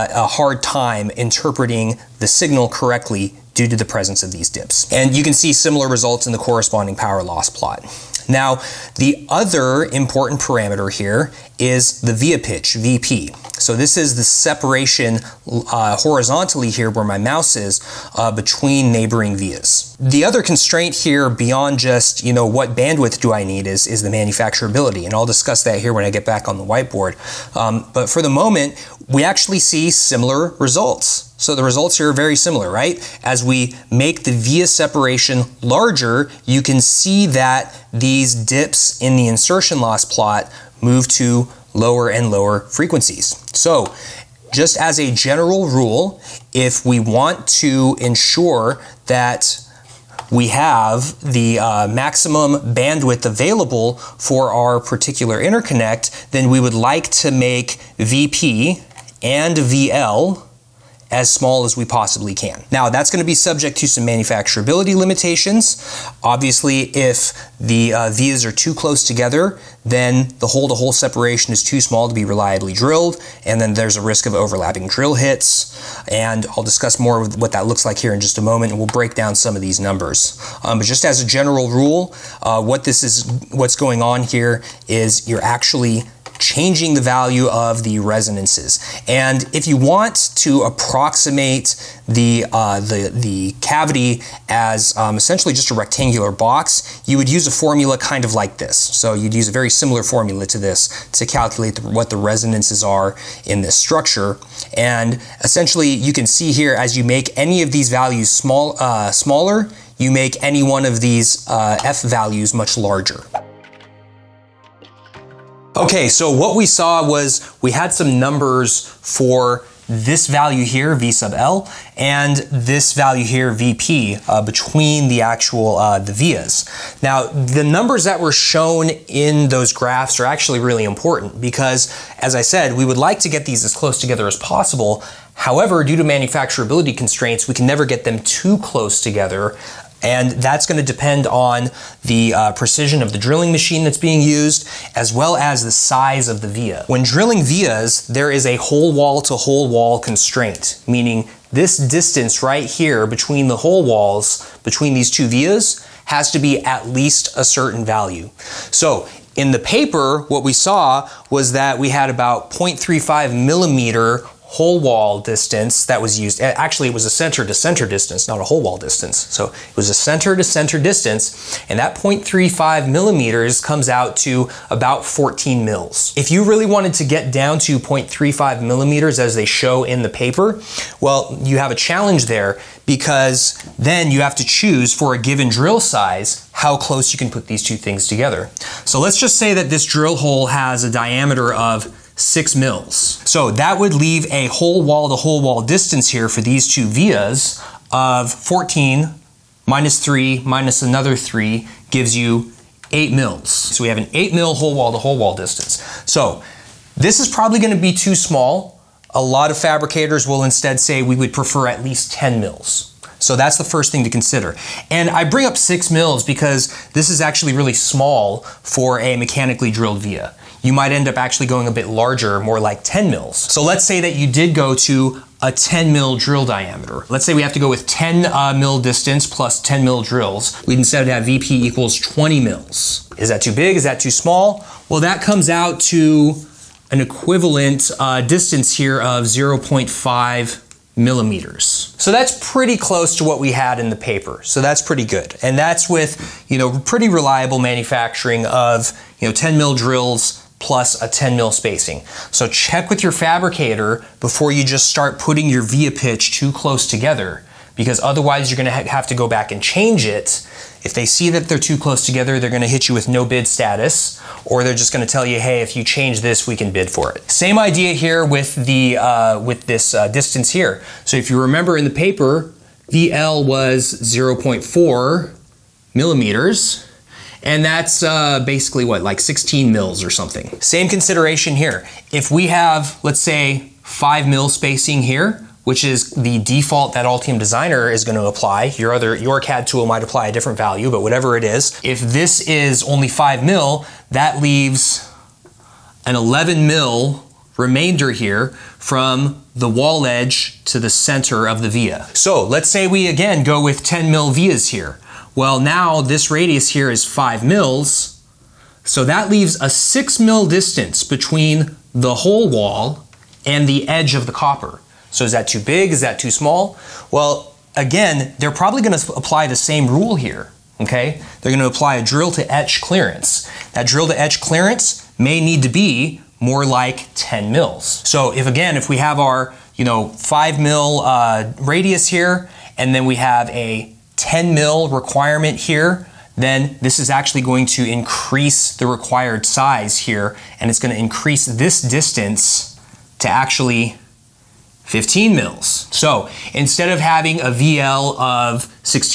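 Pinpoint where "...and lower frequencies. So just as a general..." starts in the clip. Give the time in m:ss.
0:42.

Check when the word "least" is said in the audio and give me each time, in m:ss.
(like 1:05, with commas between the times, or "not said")
2:36, 3:31.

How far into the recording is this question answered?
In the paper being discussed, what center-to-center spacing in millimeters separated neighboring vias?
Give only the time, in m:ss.
2:42.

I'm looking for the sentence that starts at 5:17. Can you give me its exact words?
Well, again, they're probably gonna apply the same rule here, okay?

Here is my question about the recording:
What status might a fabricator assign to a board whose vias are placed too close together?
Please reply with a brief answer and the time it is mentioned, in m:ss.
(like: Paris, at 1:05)
no bid, at 4:23.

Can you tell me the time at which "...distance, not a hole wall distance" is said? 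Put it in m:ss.
2:47.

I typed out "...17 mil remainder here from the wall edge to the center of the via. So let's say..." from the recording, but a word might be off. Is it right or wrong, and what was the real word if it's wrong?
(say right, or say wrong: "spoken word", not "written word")
wrong: "11", not "17".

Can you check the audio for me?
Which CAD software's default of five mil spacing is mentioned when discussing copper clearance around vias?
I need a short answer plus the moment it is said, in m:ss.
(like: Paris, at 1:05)
Altium Designer, at 4:47.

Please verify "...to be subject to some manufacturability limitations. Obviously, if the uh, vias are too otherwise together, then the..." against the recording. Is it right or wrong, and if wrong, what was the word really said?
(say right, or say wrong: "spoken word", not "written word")
wrong: "close", not "otherwise".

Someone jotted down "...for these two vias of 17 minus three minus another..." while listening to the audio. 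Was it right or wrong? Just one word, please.
wrong.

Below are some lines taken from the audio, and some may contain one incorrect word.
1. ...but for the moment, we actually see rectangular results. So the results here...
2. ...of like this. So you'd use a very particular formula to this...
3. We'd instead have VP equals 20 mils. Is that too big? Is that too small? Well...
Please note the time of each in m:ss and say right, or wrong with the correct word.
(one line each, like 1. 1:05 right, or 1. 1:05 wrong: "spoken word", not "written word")
1. 0:27 wrong: "similar", not "rectangular"
2. 1:38 wrong: "similar", not "particular"
3. 3:50 right.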